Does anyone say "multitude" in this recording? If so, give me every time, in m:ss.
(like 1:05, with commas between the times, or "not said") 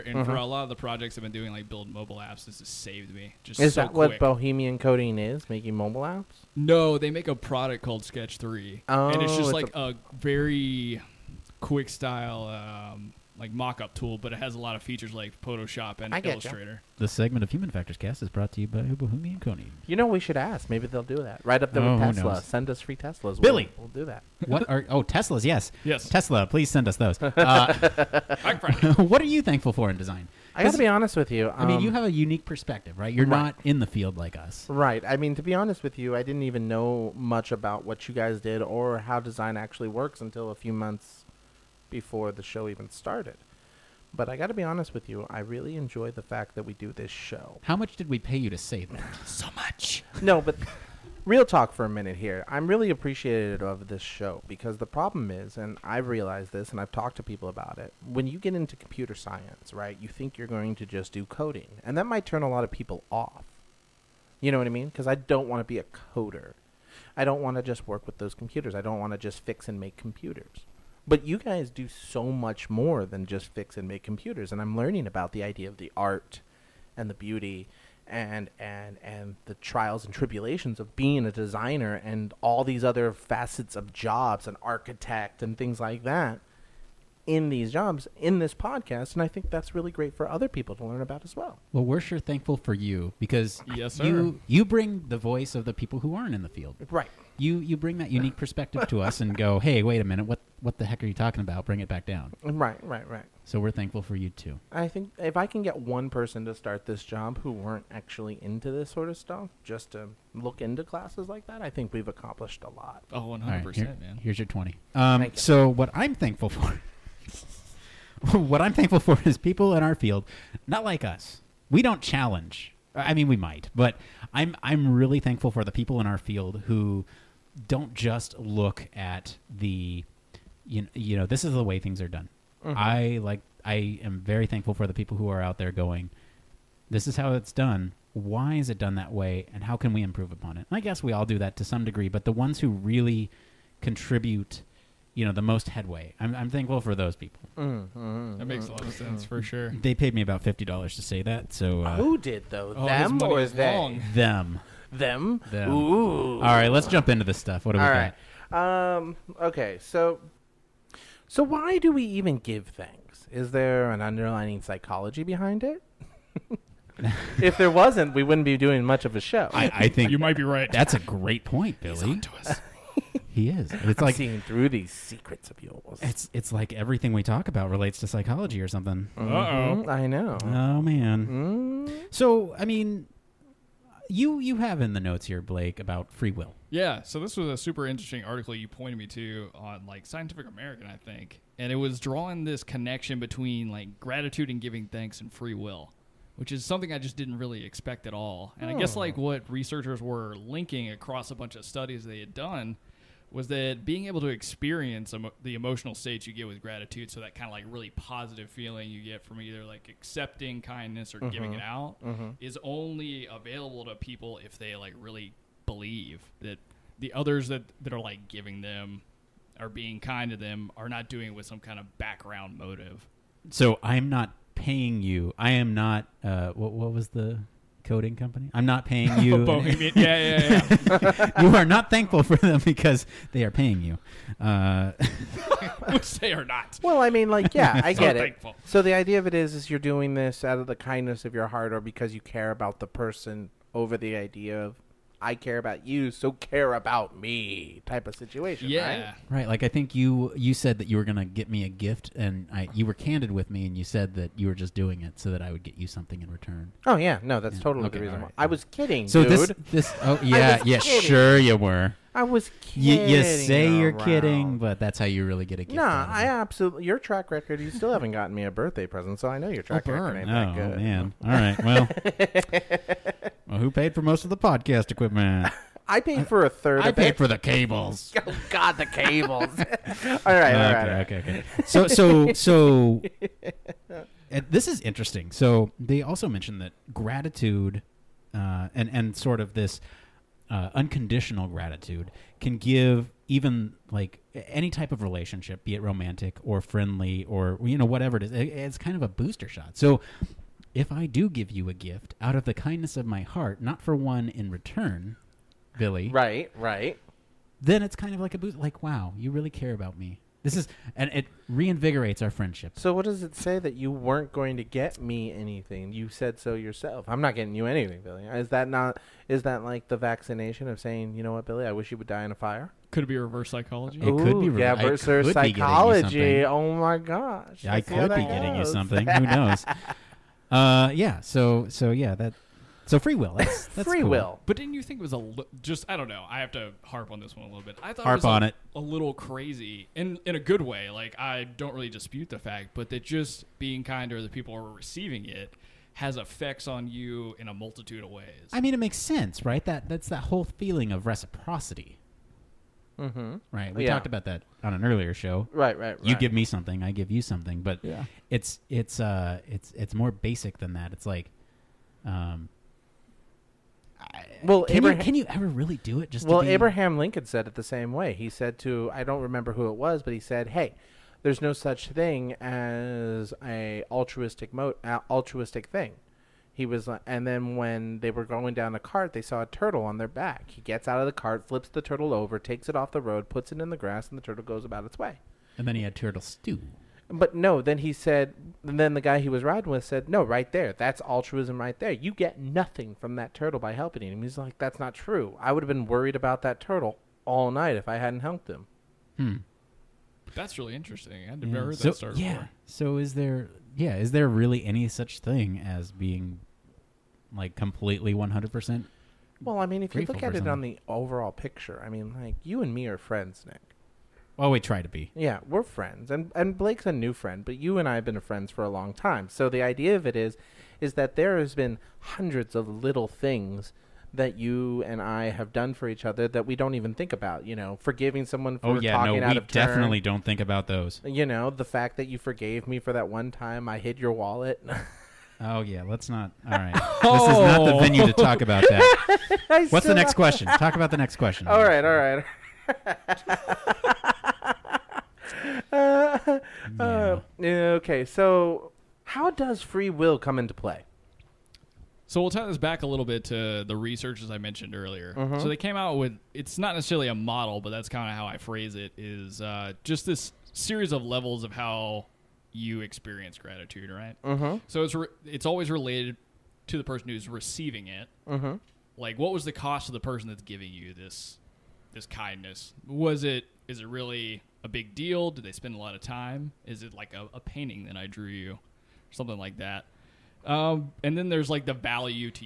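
5:47.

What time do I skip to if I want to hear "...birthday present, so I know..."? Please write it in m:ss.
4:28.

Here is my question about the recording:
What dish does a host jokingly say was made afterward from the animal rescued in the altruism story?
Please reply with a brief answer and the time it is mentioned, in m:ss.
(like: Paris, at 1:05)
Turtle stew, at 6:25.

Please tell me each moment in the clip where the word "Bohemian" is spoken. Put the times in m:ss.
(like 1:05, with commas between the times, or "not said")
0:04, 3:49.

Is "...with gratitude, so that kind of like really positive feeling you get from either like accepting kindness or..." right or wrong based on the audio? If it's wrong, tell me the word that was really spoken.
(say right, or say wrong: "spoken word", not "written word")
right.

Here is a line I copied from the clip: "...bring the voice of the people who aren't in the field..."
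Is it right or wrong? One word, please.
right.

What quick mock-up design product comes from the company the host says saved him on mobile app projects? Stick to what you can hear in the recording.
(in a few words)
Sketch Three.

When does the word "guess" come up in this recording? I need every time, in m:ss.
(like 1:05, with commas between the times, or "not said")
2:20, 3:18.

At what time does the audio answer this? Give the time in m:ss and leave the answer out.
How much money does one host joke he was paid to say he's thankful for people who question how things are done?
2:30.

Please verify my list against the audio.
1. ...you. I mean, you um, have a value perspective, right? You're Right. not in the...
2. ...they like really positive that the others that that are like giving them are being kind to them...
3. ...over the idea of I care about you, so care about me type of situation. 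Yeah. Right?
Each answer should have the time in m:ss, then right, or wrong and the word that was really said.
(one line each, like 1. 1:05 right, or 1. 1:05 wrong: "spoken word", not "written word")
1. 0:31 wrong: "unique", not "value"
2. 3:34 wrong: "believe", not "positive"
3. 4:03 right.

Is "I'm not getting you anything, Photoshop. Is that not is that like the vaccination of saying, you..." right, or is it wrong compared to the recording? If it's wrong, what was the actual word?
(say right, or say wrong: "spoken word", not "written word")
wrong: "Billy", not "Photoshop".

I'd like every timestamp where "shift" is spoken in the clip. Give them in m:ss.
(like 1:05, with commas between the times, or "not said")
not said.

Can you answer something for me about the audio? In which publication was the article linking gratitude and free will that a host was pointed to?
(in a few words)
Scientific American.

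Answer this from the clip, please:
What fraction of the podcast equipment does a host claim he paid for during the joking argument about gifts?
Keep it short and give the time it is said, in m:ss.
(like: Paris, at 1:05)
A third, at 4:36.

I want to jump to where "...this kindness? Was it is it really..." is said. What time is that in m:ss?
7:51.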